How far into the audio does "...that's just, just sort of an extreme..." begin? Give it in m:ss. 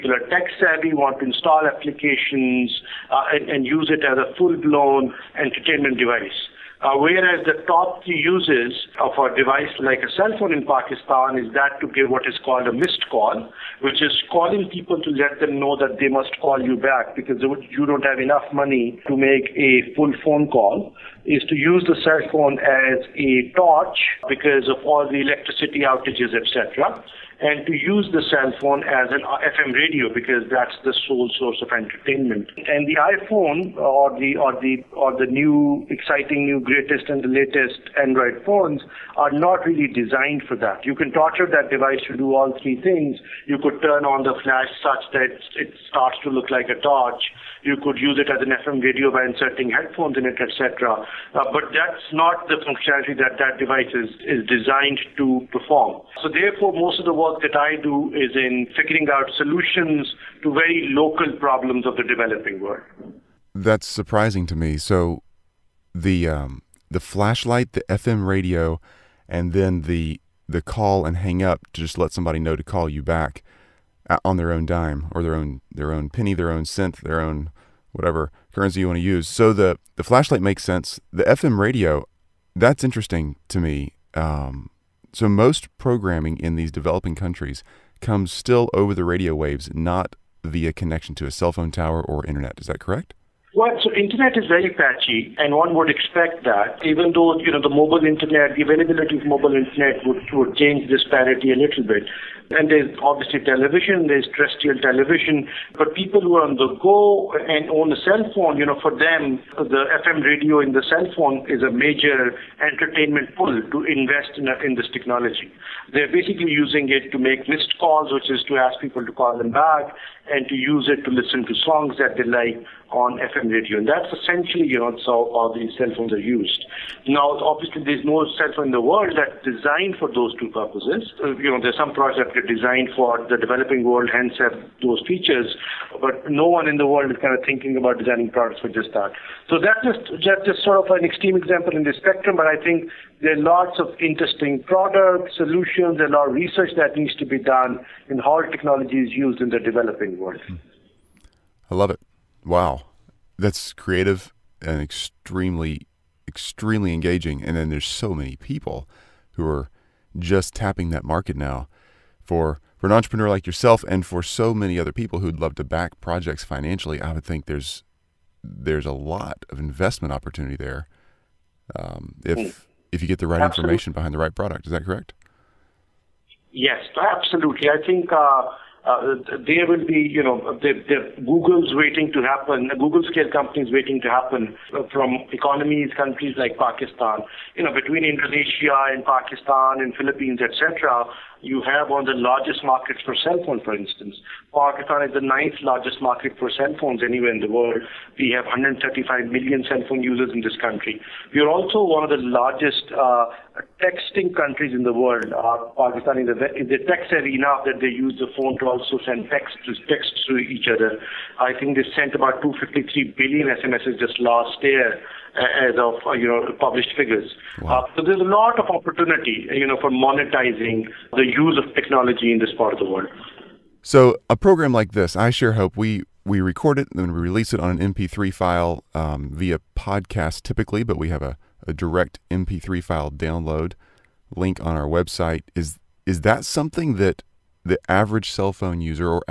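2:19.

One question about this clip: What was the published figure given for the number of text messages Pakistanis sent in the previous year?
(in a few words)
253 billion.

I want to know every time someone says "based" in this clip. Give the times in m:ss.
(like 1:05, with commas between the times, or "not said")
not said.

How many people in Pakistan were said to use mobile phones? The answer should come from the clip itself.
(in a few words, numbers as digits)
135 million.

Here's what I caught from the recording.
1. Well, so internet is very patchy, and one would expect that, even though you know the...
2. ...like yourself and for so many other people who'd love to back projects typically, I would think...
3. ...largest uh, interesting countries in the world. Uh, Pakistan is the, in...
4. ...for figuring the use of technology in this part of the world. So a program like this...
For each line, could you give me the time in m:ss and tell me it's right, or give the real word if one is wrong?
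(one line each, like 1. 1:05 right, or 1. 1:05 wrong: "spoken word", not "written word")
1. 1:33 right
2. 2:43 wrong: "financially", not "typically"
3. 3:22 wrong: "texting", not "interesting"
4. 3:39 wrong: "monetizing", not "figuring".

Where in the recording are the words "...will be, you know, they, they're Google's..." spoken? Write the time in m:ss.
2:59.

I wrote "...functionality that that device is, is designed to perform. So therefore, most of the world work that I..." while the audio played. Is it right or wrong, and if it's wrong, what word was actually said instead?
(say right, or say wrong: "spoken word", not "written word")
right.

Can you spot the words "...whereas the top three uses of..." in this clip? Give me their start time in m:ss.
0:06.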